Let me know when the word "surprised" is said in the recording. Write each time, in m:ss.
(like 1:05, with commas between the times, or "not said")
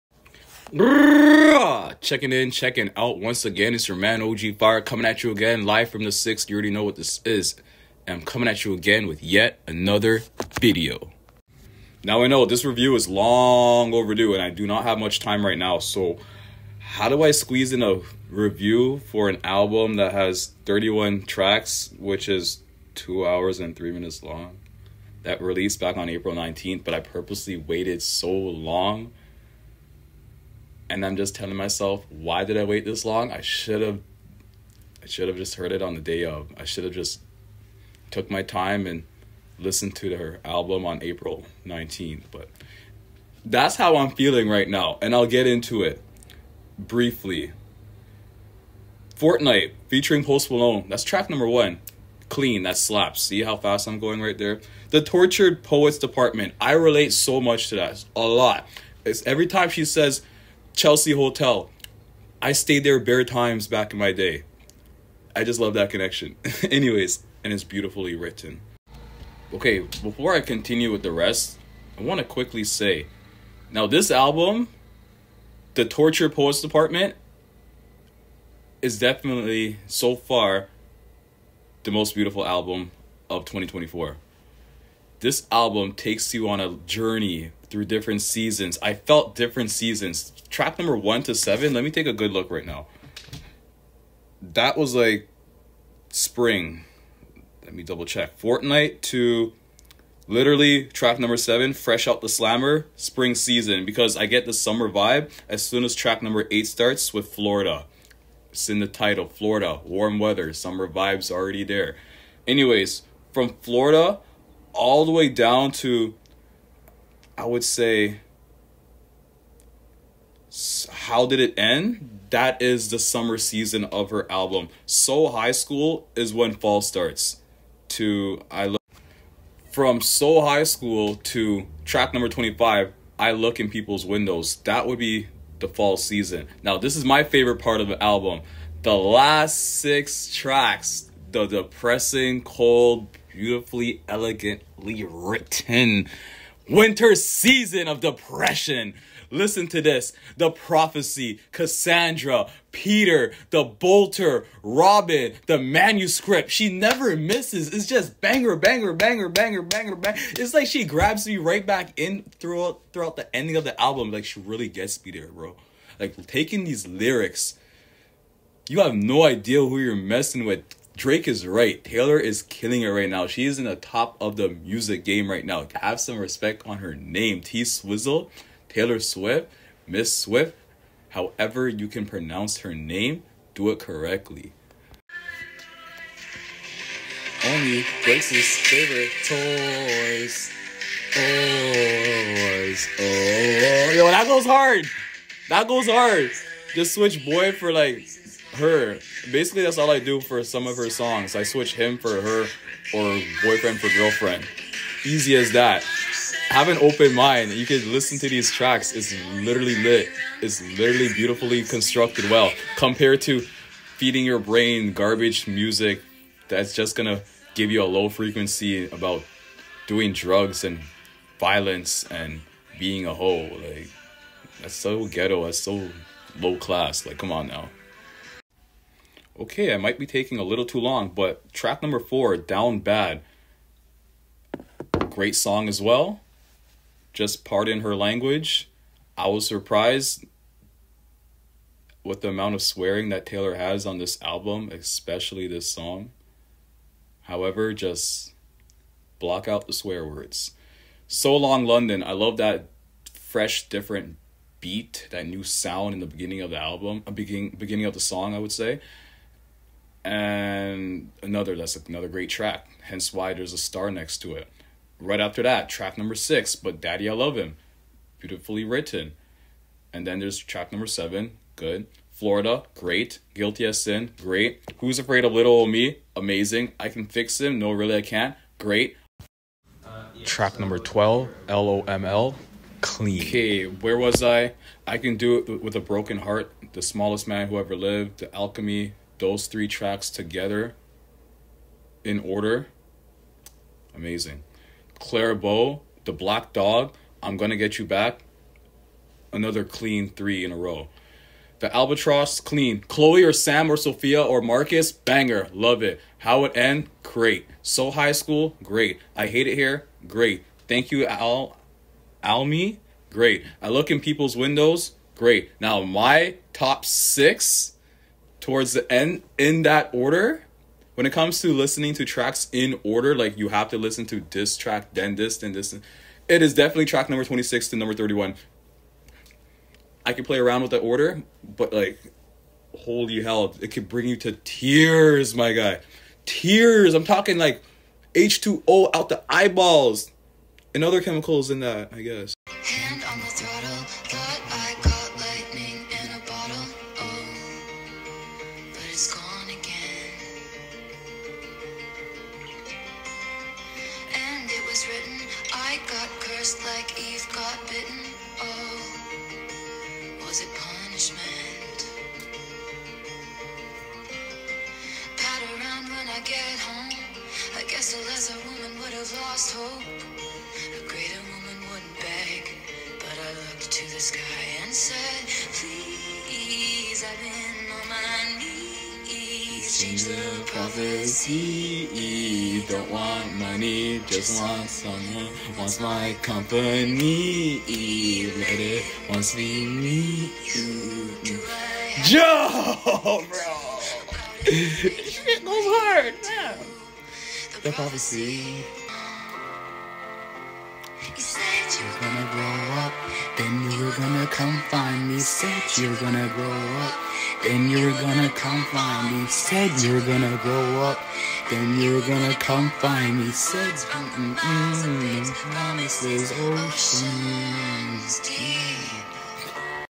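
3:59.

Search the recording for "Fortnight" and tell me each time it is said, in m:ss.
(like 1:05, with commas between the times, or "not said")
0:49, 1:38.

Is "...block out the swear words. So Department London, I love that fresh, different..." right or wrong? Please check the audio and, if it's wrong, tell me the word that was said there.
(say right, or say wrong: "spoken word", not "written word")
wrong: "Long", not "Department".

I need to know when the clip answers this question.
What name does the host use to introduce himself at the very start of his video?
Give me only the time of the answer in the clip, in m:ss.
0:04.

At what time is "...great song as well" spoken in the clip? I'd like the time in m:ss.
3:55.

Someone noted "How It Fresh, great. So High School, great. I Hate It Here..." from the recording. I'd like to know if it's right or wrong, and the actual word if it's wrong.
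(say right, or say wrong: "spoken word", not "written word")
wrong: "End", not "Fresh".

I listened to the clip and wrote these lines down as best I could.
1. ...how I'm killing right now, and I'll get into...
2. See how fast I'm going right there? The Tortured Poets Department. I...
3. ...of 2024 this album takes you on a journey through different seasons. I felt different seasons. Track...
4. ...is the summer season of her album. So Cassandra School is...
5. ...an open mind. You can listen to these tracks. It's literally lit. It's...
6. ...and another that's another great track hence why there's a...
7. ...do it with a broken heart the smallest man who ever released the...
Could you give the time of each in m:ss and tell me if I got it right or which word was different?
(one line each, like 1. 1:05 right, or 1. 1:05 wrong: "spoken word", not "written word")
1. 0:43 wrong: "feeling", not "killing"
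2. 0:53 right
3. 1:23 right
4. 2:02 wrong: "High", not "Cassandra"
5. 3:26 right
6. 4:20 right
7. 4:45 wrong: "lived", not "released".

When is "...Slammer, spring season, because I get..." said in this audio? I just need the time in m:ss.
1:42.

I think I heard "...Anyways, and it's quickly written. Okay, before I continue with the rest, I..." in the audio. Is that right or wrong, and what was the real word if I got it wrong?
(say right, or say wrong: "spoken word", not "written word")
wrong: "beautifully", not "quickly".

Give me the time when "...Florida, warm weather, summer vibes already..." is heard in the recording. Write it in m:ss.
1:49.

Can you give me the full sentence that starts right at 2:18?
The last six tracks, the depressing, cold, beautifully, elegantly written winter season of depression.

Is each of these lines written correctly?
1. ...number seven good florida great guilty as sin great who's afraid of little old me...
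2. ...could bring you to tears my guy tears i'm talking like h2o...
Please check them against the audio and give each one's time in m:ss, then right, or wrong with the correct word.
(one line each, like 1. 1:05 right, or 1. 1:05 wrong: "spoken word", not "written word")
1. 4:30 right
2. 5:33 right.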